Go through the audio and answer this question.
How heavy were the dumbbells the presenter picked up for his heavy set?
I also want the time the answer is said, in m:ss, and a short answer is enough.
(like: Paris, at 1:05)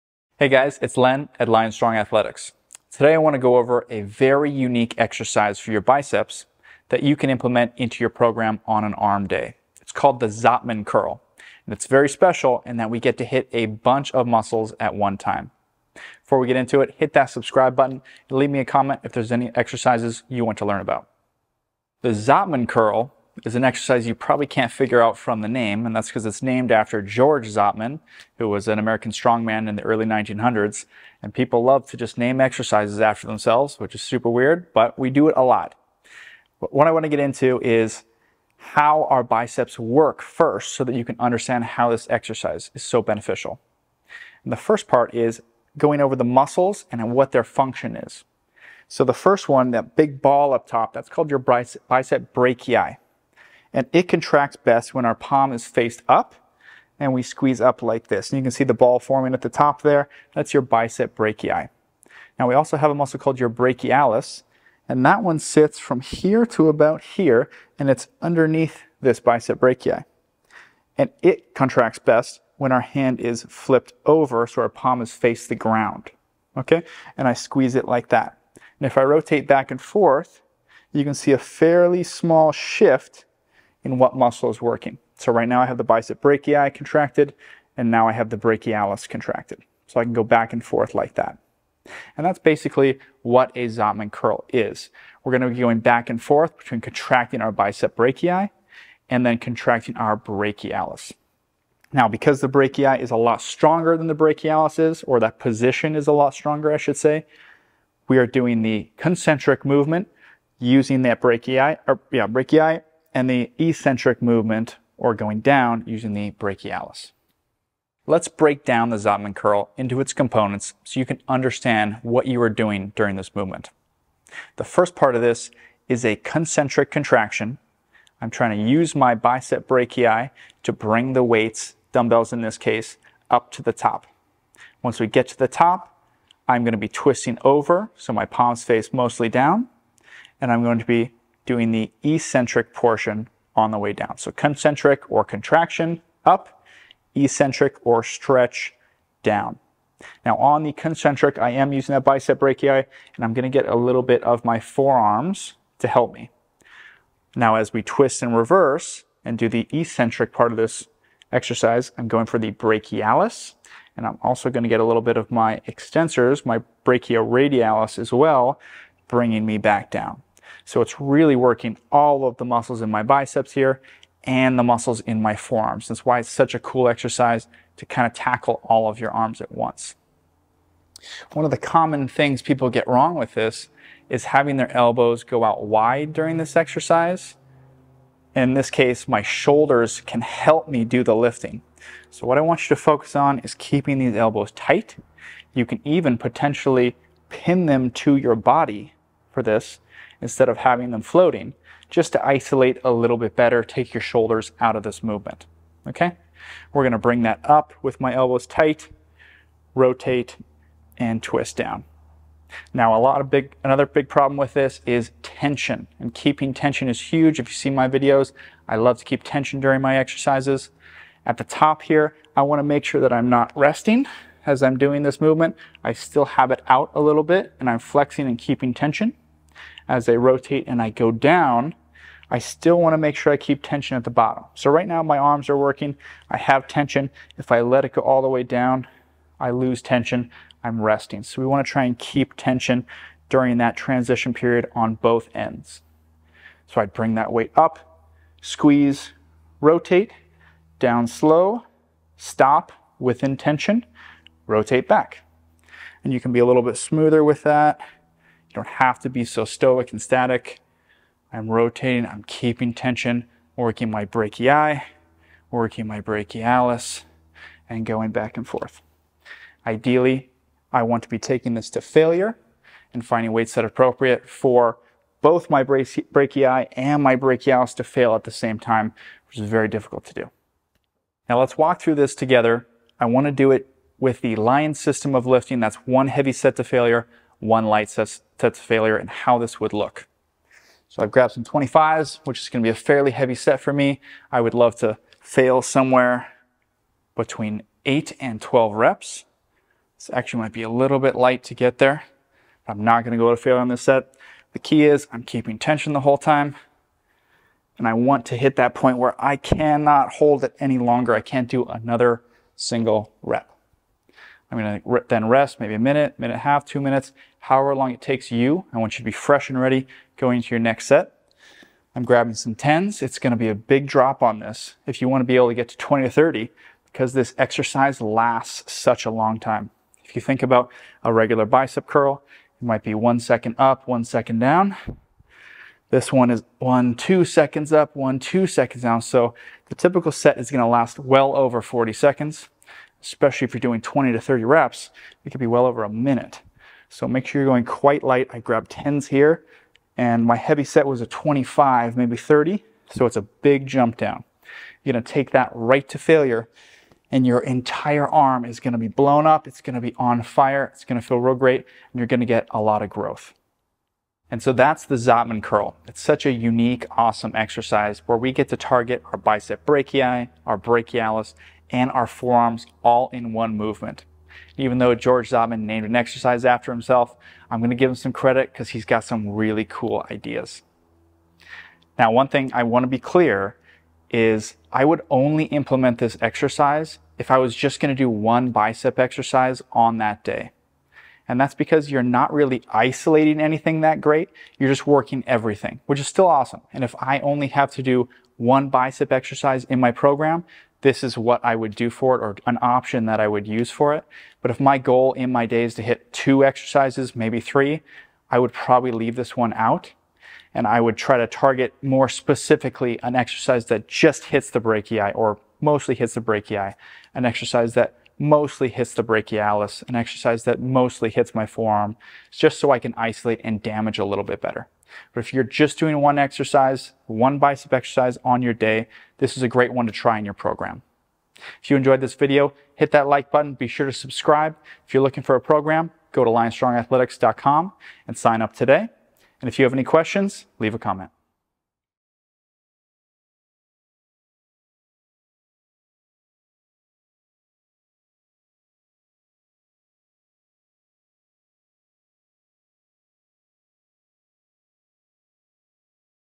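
25, at 4:51.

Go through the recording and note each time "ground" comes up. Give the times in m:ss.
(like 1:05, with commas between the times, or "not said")
1:15.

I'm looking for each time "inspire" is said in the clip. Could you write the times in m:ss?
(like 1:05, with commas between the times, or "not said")
not said.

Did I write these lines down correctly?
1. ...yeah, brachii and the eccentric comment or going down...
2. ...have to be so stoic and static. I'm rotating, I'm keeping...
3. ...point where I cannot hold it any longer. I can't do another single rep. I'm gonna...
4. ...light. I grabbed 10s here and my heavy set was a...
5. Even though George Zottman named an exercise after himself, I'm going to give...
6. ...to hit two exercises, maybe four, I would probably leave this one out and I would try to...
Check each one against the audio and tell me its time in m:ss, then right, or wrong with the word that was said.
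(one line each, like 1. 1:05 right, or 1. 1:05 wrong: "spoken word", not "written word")
1. 1:52 wrong: "movement", not "comment"
2. 4:18 right
3. 5:08 right
4. 5:48 right
5. 6:14 right
6. 6:45 wrong: "three", not "four".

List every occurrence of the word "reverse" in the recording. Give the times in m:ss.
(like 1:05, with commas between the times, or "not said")
2:38.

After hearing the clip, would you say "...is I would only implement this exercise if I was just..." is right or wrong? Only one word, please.
right.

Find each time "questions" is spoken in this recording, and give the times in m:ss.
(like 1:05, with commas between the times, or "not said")
7:19.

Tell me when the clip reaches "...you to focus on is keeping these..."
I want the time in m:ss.
3:12.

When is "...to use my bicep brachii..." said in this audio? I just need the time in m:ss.
2:08.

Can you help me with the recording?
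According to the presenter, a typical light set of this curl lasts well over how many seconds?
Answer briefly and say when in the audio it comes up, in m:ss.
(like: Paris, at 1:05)
40, at 5:41.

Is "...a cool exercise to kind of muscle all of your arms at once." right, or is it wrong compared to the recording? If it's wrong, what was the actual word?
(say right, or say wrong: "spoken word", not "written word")
wrong: "tackle", not "muscle".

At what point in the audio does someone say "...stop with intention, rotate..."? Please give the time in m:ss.
4:12.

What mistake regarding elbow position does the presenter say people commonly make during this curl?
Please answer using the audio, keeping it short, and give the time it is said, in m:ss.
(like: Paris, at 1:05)
elbows go out wide, at 3:04.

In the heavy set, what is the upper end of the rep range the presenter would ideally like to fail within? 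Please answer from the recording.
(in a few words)
12.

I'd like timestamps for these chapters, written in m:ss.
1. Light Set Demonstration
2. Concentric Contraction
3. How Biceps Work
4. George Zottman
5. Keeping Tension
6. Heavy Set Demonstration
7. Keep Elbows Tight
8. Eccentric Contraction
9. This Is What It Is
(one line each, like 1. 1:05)
1. 5:14
2. 1:58
3. 0:37
4. 0:22
5. 3:34
6. 4:40
7. 3:01
8. 2:36
9. 1:30.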